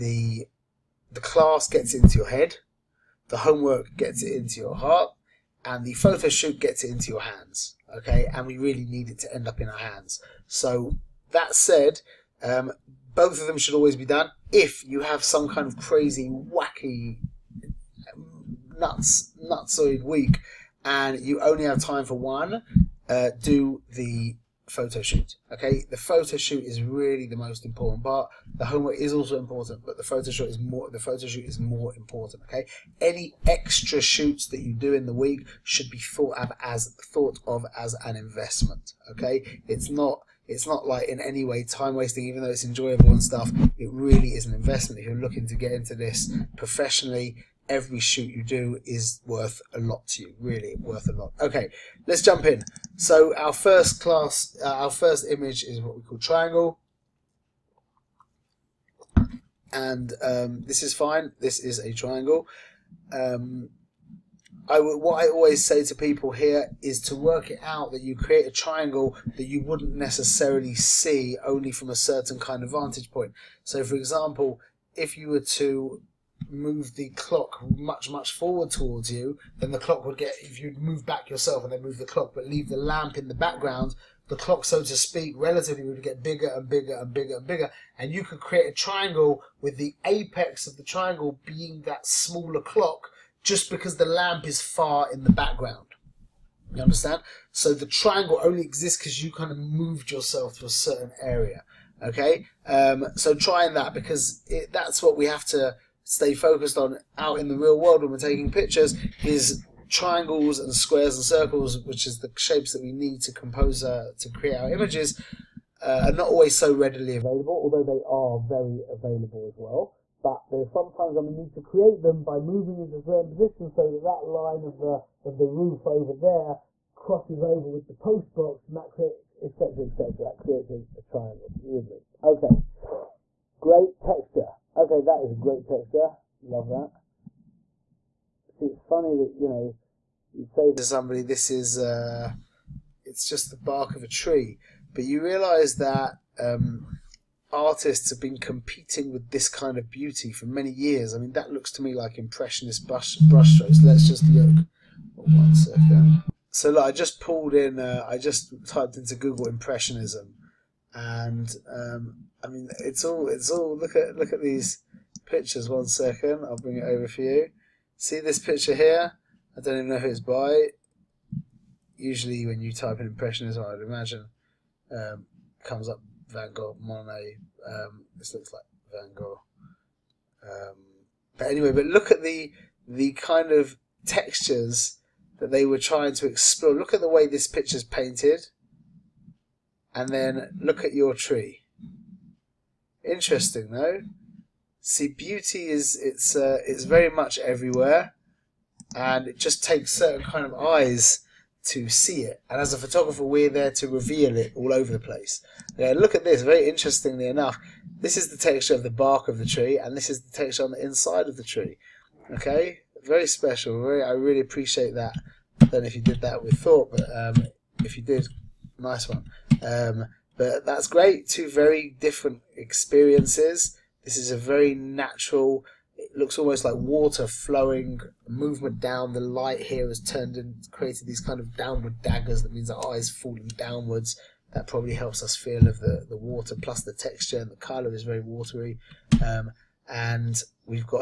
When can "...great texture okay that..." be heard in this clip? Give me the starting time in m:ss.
2:13.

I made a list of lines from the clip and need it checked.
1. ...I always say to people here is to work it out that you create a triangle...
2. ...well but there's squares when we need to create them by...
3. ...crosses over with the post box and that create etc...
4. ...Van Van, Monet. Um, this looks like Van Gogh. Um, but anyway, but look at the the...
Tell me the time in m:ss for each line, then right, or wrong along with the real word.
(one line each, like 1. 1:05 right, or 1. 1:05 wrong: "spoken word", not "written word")
1. 1:05 right
2. 1:59 wrong: "sometimes", not "squares"
3. 2:06 right
4. 2:56 wrong: "Gogh", not "Van".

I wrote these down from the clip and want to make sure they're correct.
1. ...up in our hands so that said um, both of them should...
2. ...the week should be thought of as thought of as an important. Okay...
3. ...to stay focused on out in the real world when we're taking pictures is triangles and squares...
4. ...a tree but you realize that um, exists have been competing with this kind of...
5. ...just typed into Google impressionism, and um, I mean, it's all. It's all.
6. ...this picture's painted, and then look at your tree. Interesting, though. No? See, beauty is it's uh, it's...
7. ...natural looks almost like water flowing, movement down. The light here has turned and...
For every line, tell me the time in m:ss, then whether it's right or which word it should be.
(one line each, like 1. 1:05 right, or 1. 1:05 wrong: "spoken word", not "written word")
1. 0:09 right
2. 0:35 wrong: "investment", not "important"
3. 1:45 right
4. 2:24 wrong: "artists", not "exists"
5. 2:38 right
6. 3:07 right
7. 3:44 right.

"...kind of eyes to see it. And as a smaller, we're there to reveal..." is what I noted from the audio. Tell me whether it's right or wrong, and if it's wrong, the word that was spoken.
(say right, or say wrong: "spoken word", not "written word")
wrong: "photographer", not "smaller".